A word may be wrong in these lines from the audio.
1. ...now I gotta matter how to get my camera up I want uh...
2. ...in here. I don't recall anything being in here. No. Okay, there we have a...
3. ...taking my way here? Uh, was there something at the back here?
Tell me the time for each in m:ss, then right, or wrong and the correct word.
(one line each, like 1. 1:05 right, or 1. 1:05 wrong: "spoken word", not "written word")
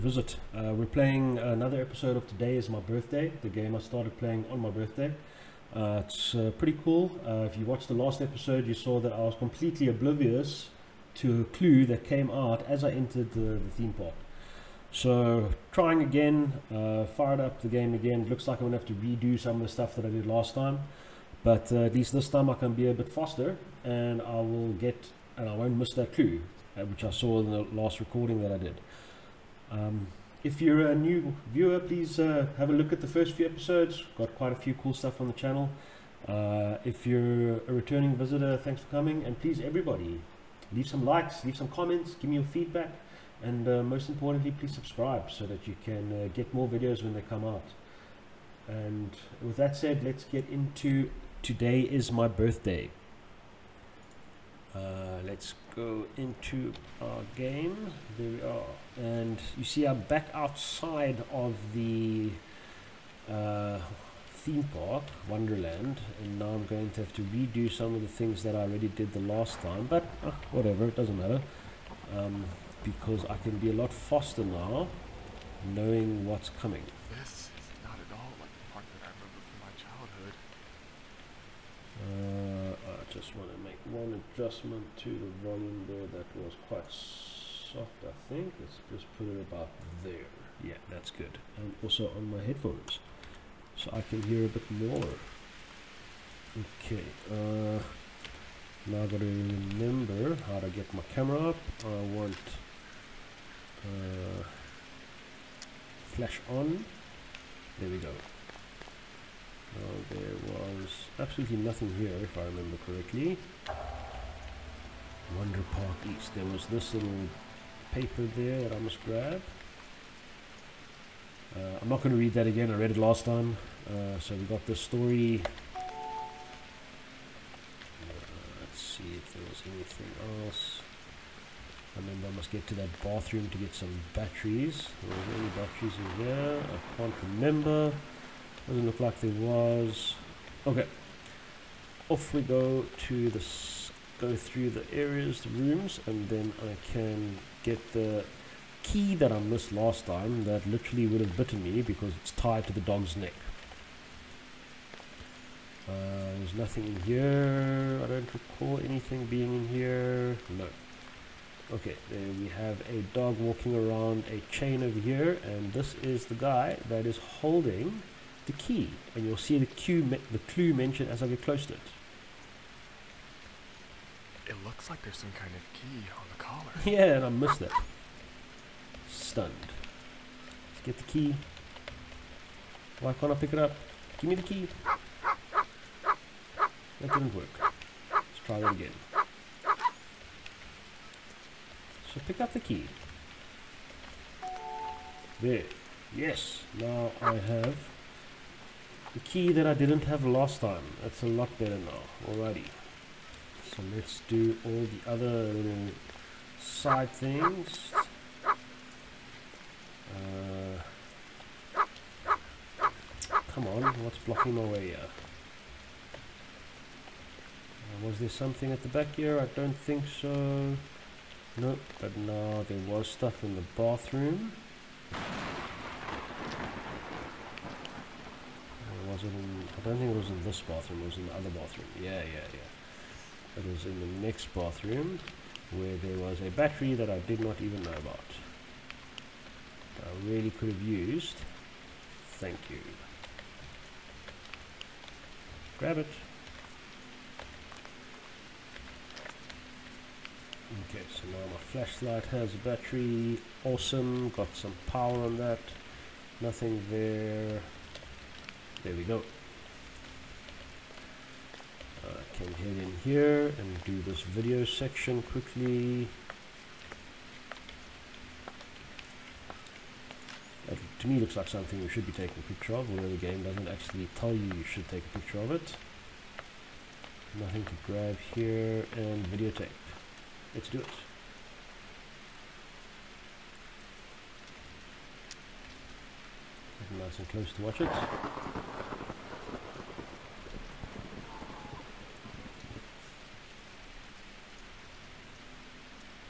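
1. 1:38 wrong: "remember", not "matter"
2. 2:36 right
3. 3:34 wrong: "blocking", not "taking".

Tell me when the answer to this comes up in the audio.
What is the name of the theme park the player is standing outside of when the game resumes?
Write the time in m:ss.
1:05.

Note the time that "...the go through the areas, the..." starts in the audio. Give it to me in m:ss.
2:23.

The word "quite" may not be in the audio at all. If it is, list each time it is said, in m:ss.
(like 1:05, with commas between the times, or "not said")
0:34, 1:26.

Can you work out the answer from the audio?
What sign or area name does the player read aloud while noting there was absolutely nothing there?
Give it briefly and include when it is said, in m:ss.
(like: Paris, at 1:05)
Wonder Park East, at 1:55.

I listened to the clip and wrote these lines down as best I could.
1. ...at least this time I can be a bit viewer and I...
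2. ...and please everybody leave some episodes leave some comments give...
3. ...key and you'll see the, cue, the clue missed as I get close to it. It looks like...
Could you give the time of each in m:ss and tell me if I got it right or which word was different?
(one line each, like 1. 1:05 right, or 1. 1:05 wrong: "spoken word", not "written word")
1. 0:21 wrong: "faster", not "viewer"
2. 0:39 wrong: "likes", not "episodes"
3. 2:48 wrong: "mentioned", not "missed".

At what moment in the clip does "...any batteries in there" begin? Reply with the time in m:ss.
2:15.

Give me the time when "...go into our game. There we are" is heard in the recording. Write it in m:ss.
0:55.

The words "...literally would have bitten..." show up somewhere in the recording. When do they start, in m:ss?
2:30.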